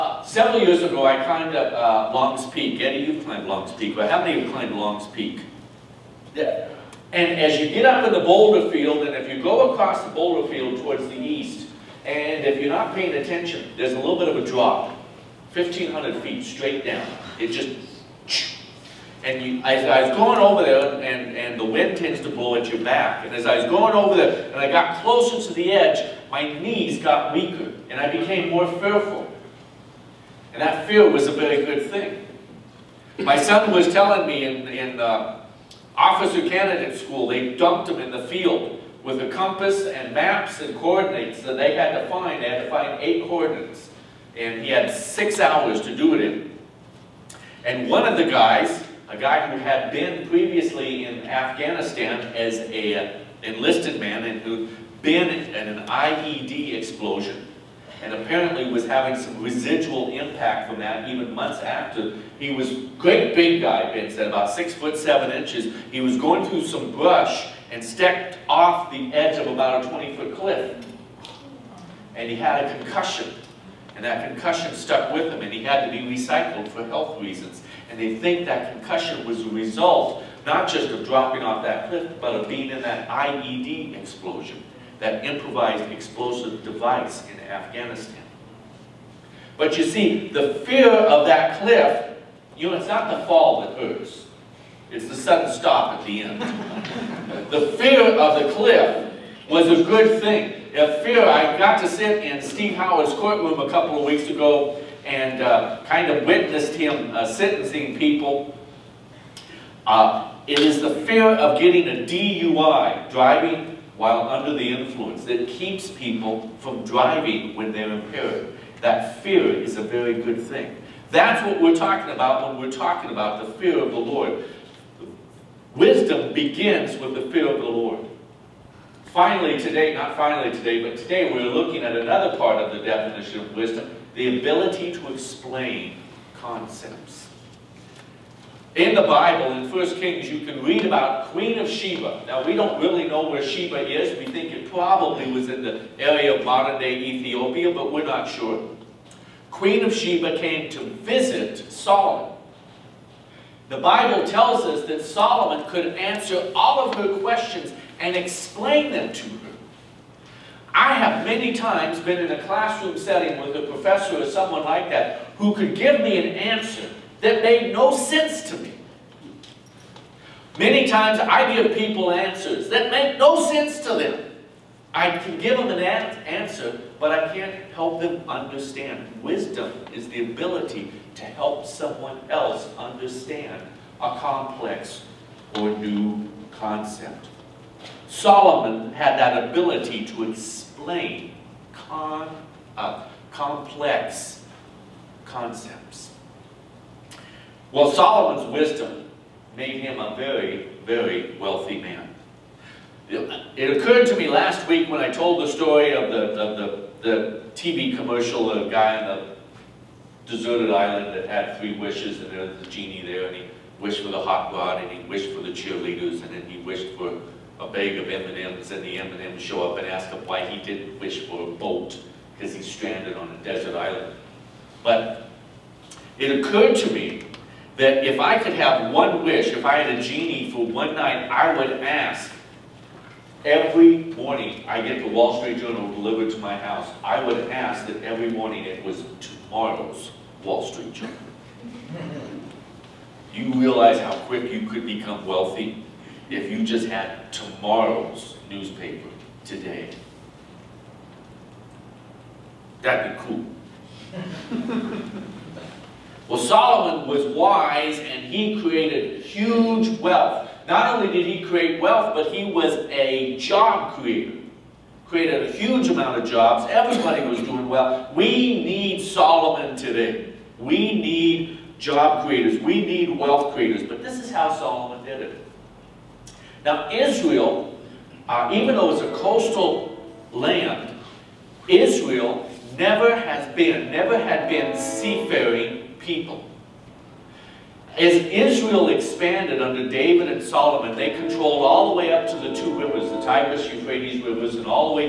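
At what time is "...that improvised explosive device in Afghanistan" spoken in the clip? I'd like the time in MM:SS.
01:24.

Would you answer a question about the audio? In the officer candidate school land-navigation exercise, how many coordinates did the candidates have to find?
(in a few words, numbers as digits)
8.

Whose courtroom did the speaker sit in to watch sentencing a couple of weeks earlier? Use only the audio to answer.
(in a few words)
Steve Howard.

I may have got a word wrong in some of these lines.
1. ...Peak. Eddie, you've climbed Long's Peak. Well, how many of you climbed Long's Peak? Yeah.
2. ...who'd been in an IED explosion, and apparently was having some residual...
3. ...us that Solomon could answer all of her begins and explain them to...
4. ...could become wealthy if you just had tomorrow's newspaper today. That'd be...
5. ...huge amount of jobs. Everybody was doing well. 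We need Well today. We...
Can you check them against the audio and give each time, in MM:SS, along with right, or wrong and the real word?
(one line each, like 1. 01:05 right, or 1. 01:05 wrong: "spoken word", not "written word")
1. 00:02 right
2. 00:54 right
3. 02:34 wrong: "questions", not "begins"
4. 04:04 right
5. 04:25 wrong: "Solomon", not "Well".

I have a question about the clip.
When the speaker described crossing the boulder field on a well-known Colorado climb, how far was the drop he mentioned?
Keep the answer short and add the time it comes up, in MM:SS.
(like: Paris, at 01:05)
1,500 feet, at 00:15.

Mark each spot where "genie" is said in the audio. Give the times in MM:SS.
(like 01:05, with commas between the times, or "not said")
03:32, 03:50.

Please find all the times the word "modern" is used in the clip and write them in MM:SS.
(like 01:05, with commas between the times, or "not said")
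02:26.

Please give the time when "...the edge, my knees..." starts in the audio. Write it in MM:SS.
00:25.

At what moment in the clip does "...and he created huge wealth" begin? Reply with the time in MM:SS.
04:17.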